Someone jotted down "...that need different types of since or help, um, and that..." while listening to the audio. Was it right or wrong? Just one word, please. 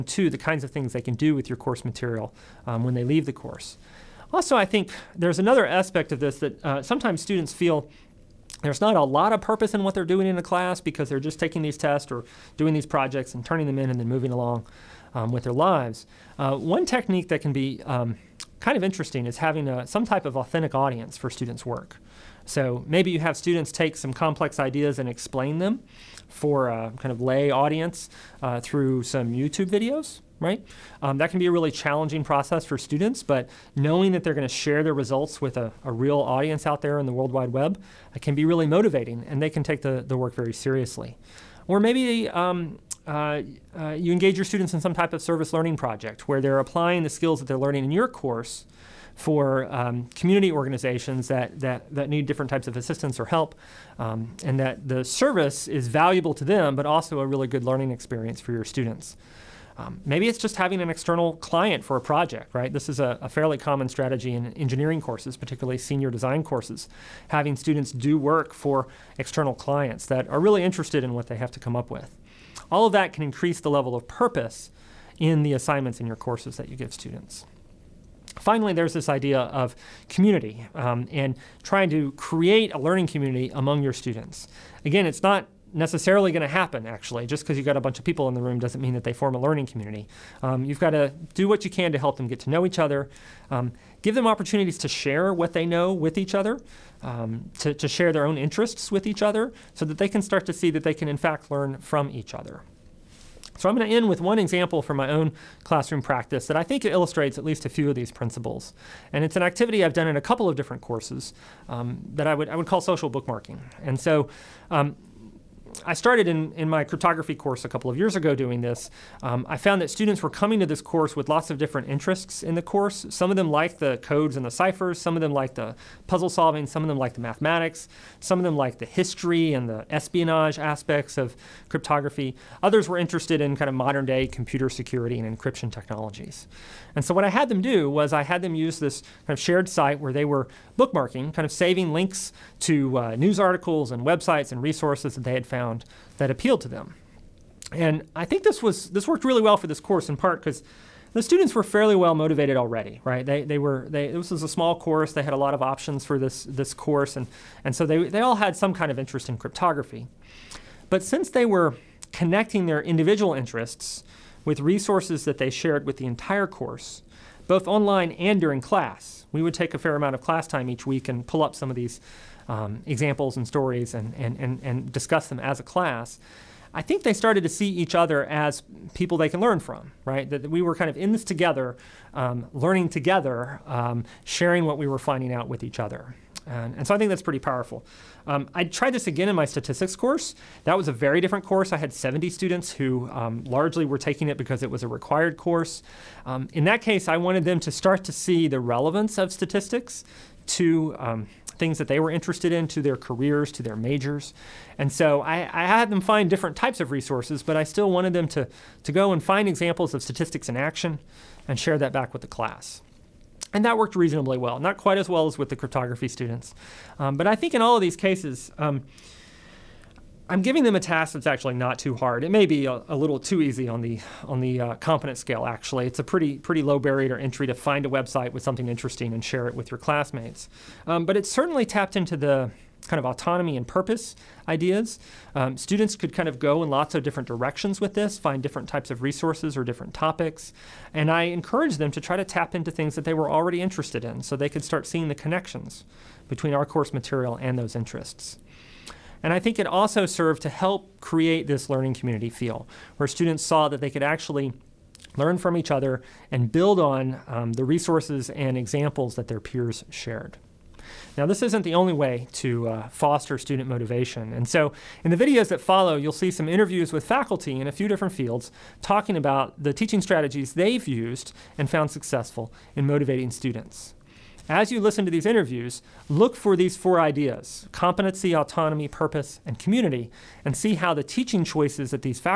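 wrong.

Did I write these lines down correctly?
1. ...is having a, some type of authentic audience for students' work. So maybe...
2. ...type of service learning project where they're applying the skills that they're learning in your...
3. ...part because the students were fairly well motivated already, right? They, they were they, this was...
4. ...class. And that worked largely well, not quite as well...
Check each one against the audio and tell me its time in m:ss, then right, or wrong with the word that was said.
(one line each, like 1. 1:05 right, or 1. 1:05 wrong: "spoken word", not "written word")
1. 0:19 right
2. 0:44 right
3. 2:30 right
4. 3:32 wrong: "reasonably", not "largely".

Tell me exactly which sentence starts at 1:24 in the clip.
Again, it's not necessarily going to happen, actually.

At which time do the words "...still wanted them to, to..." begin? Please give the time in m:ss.
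3:27.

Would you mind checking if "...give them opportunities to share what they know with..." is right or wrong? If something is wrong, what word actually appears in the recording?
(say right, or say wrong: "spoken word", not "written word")
right.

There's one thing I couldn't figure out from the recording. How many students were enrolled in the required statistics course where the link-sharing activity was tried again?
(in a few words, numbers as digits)
70.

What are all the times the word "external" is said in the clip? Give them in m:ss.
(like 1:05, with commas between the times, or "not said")
1:00, 1:09.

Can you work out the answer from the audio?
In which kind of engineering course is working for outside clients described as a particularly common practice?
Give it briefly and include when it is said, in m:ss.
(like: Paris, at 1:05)
senior design courses, at 1:05.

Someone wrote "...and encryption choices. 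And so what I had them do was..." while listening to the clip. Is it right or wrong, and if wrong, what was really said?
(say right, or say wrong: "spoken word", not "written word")
wrong: "technologies", not "choices".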